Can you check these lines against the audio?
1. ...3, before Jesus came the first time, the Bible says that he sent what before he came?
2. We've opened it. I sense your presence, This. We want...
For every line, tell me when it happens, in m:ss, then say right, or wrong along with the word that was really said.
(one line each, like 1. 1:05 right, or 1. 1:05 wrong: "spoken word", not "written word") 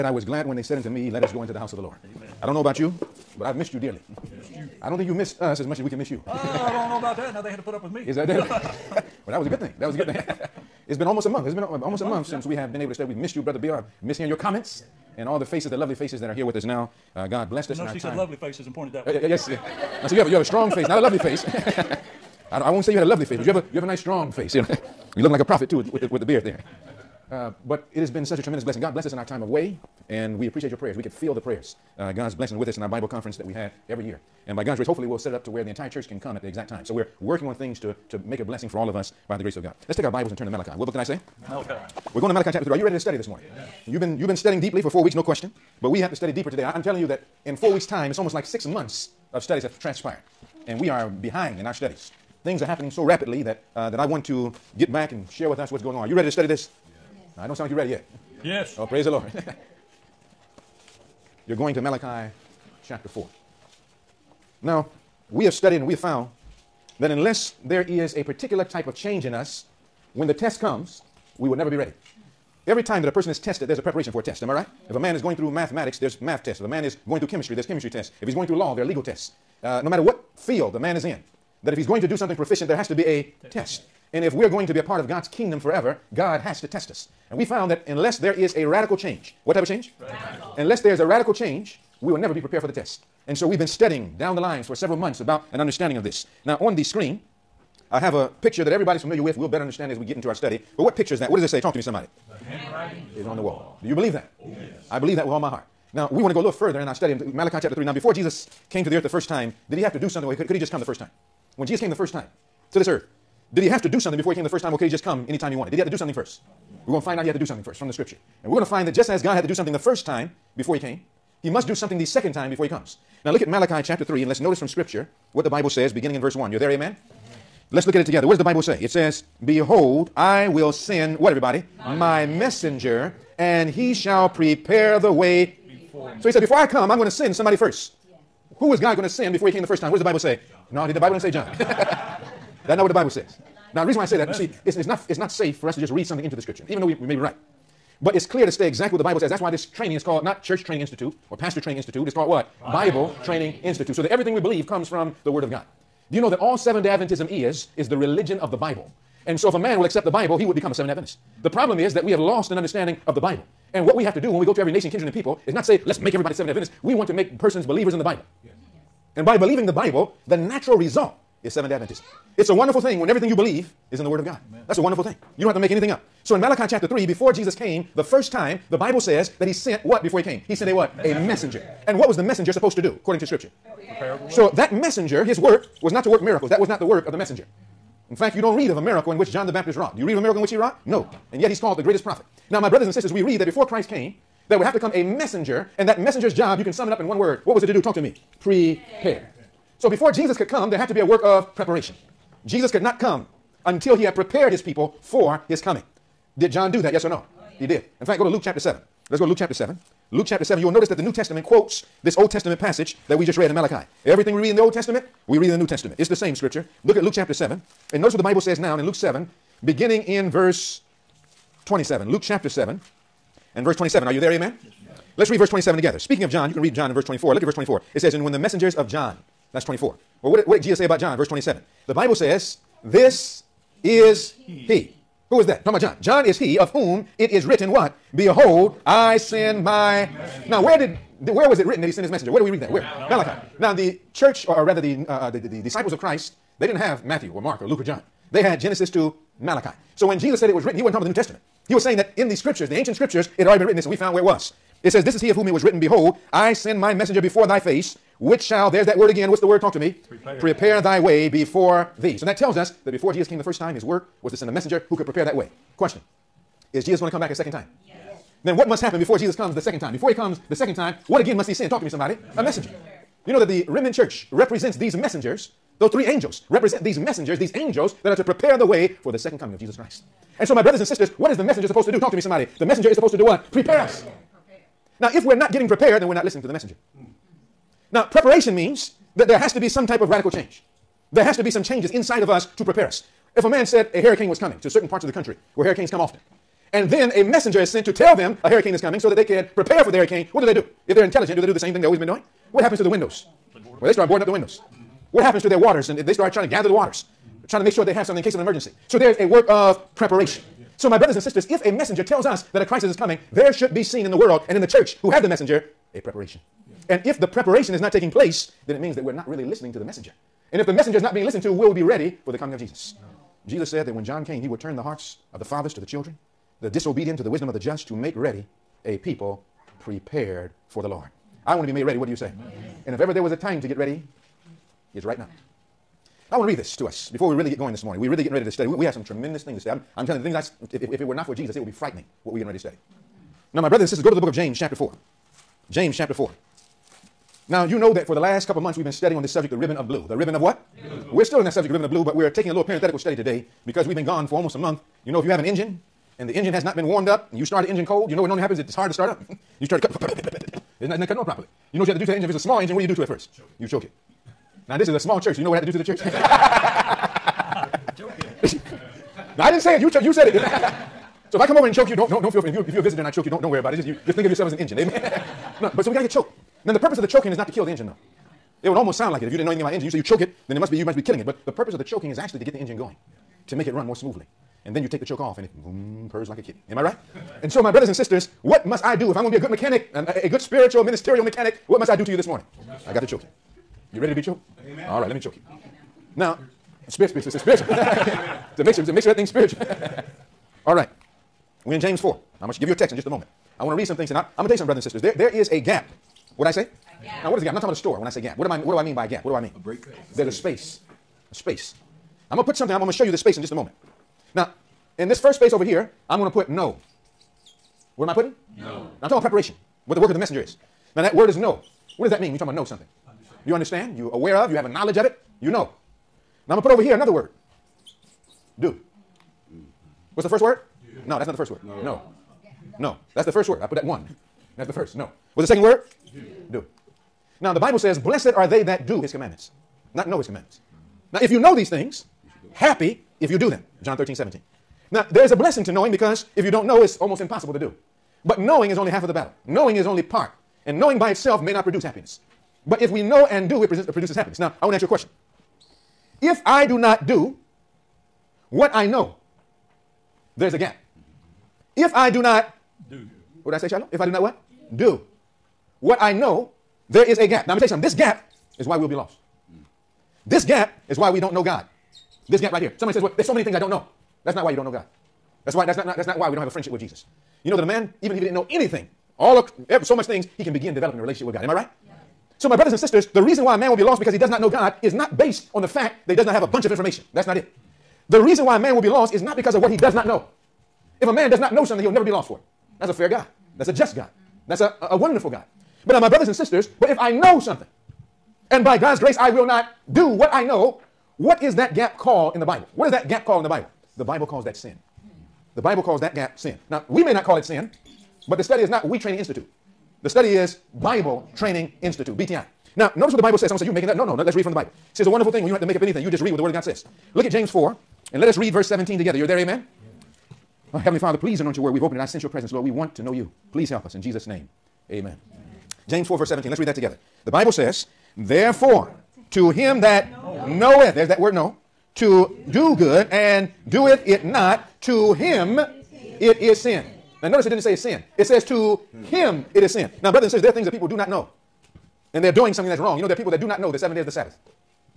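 1. 2:56 right
2. 8:41 wrong: "Lord", not "This".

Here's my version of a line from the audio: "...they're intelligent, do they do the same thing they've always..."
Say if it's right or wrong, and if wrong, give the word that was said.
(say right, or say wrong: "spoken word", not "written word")
right.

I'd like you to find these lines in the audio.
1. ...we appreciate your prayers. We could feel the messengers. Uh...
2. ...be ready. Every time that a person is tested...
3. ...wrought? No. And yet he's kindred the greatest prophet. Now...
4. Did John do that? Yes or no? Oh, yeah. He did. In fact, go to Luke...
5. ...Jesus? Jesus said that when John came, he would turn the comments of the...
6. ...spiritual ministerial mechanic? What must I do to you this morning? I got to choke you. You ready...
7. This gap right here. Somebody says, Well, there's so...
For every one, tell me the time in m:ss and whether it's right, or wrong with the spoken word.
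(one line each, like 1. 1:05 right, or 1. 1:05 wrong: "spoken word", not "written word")
1. 0:30 wrong: "prayers", not "messengers"
2. 1:11 right
3. 3:10 wrong: "called", not "kindred"
4. 3:26 right
5. 5:22 wrong: "hearts", not "comments"
6. 6:30 right
7. 7:52 right.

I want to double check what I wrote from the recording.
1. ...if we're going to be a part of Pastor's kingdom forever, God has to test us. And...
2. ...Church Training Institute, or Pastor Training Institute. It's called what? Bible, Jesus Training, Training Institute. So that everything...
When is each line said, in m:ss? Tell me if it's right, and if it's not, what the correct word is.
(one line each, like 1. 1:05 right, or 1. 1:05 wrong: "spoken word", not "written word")
1. 1:24 wrong: "God", not "Pastor"
2. 2:30 wrong: "Bible", not "Jesus".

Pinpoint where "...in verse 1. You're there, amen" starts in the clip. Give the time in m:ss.
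2:06.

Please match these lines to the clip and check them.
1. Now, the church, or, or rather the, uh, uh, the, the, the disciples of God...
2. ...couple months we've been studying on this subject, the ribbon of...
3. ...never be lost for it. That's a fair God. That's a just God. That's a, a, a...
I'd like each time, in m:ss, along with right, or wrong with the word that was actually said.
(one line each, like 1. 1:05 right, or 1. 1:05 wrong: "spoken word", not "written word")
1. 4:03 wrong: "Christ", not "God"
2. 5:48 right
3. 8:11 right.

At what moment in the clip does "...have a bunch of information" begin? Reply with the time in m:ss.
8:06.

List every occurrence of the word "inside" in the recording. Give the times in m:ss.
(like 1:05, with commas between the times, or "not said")
4:51.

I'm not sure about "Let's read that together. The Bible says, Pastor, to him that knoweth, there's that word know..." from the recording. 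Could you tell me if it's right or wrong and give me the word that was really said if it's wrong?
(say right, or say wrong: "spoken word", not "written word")
wrong: "Therefore", not "Pastor".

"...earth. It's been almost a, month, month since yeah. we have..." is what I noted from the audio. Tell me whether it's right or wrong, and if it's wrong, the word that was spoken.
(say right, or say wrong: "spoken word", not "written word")
wrong: "month", not "earth".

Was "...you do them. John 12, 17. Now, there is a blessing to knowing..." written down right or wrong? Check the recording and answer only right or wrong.
wrong.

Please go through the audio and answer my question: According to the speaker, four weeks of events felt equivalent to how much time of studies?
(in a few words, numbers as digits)
Six months.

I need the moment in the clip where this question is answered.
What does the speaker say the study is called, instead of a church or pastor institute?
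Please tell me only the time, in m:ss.
8:30.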